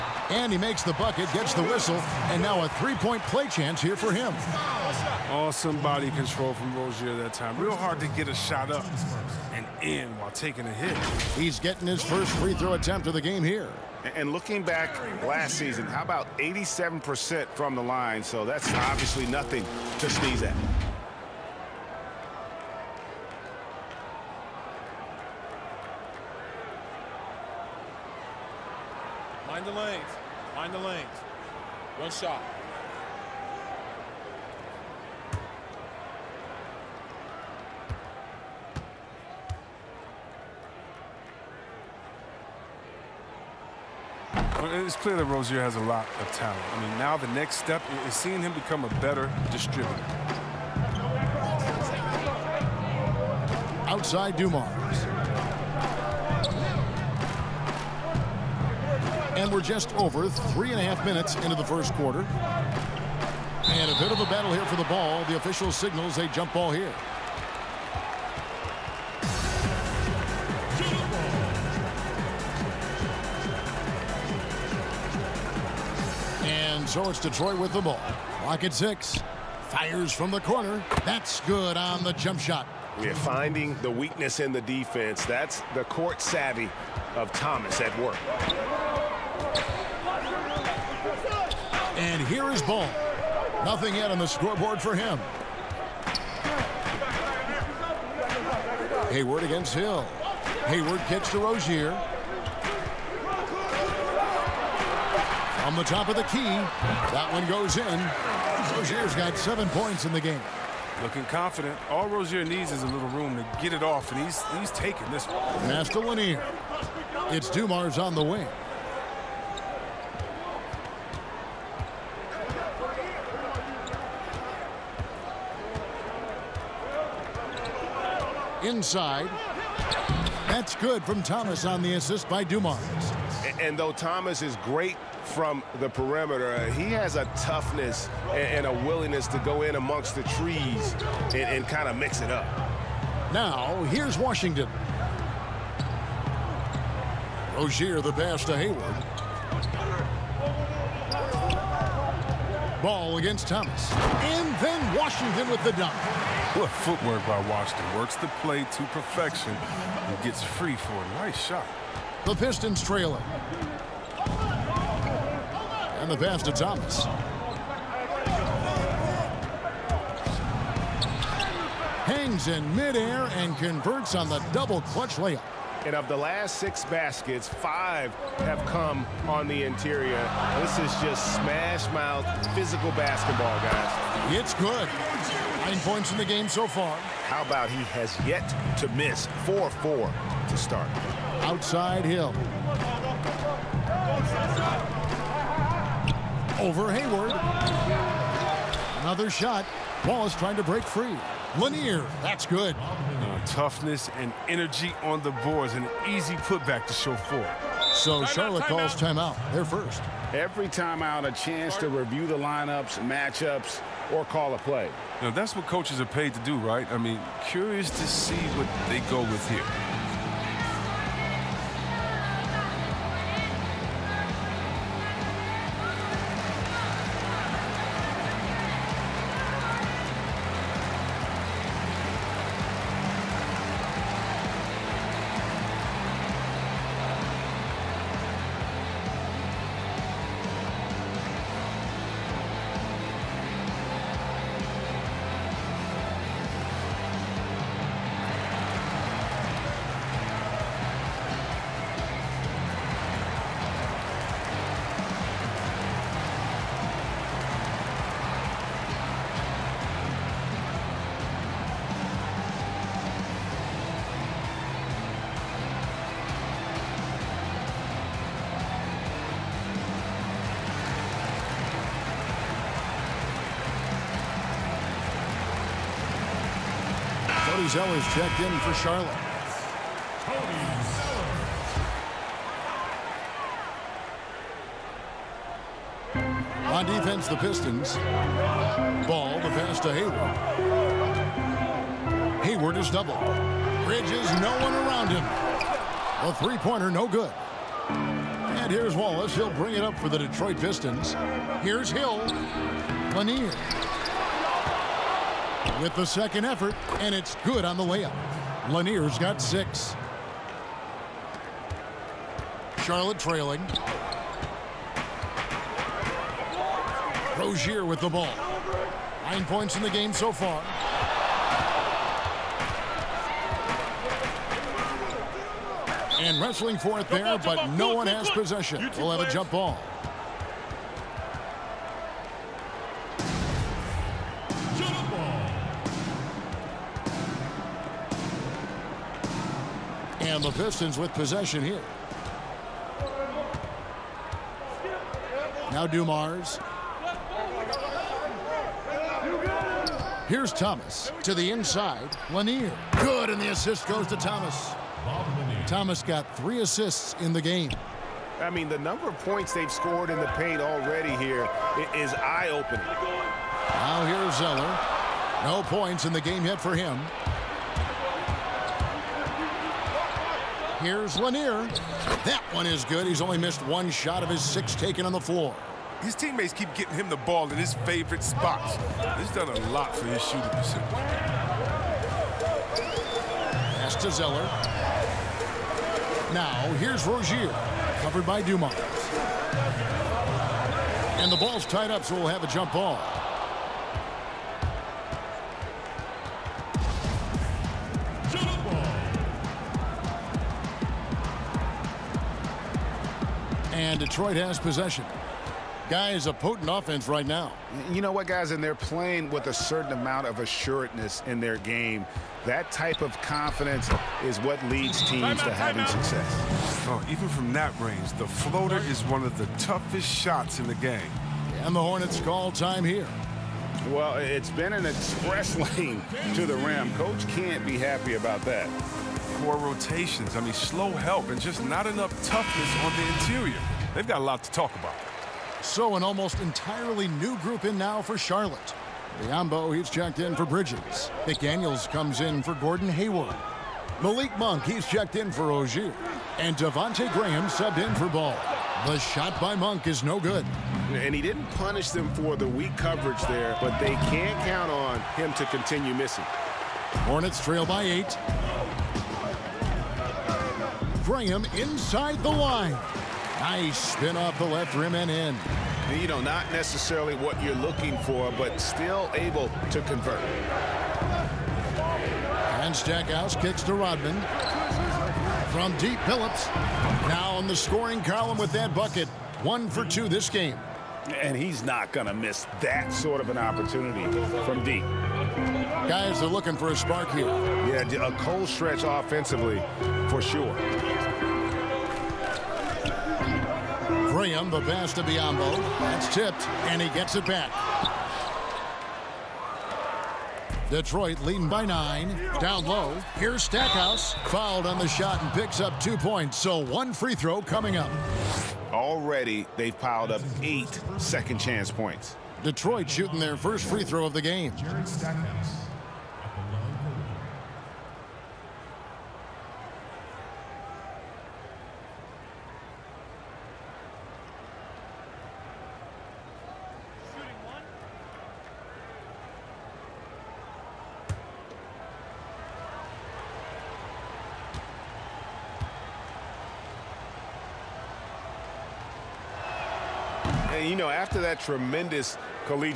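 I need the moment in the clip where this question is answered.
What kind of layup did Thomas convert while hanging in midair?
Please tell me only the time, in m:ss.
2:54.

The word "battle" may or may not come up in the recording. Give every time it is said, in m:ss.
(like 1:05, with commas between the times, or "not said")
1:04.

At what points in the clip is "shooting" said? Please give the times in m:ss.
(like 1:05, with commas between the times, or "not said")
6:20, 8:32.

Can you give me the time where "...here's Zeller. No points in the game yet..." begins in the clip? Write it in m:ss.
6:04.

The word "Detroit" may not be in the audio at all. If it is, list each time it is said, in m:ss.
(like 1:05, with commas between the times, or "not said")
1:17, 5:00, 6:44, 8:20, 8:32.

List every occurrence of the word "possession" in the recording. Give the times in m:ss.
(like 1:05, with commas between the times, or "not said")
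5:28, 5:41, 6:44.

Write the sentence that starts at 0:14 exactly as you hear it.
And looking back last season, how about 87% from the line?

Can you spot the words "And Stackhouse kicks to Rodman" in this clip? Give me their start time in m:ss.
7:52.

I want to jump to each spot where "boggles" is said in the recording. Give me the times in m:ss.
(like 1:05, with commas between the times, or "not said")
not said.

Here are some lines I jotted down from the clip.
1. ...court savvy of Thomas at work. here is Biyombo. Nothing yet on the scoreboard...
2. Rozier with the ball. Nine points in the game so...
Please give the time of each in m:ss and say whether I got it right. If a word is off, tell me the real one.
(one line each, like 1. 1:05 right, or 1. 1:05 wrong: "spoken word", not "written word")
1. 1:25 wrong: "Ball", not "Biyombo"
2. 5:17 right.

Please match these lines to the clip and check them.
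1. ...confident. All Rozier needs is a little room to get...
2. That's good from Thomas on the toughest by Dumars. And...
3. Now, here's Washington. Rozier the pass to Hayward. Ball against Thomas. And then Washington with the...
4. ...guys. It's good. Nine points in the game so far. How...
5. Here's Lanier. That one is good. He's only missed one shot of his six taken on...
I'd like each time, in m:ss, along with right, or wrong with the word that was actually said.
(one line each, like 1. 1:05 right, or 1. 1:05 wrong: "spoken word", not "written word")
1. 1:51 right
2. 2:10 wrong: "assist", not "toughest"
3. 2:23 right
4. 3:03 right
5. 6:10 right.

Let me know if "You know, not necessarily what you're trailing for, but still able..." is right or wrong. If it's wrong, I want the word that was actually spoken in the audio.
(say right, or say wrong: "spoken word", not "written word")
wrong: "looking", not "trailing".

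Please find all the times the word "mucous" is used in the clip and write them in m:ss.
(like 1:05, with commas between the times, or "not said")
not said.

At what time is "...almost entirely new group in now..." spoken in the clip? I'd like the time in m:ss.
7:16.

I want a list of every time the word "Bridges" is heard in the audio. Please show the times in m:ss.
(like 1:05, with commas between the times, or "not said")
4:53, 7:20.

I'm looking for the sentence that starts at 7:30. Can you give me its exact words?
And he didn't punish them for the weak coverage there, but they can't count on him to continue missing.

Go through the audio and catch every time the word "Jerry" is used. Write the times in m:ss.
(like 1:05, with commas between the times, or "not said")
8:34.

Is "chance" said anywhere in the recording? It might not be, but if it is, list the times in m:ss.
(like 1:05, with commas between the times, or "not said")
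0:03, 3:31, 8:31.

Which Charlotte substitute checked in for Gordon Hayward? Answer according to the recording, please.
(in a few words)
McDaniels.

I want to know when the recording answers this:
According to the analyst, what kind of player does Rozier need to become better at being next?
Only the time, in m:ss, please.
0:49.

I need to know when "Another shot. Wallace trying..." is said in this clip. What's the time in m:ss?
3:19.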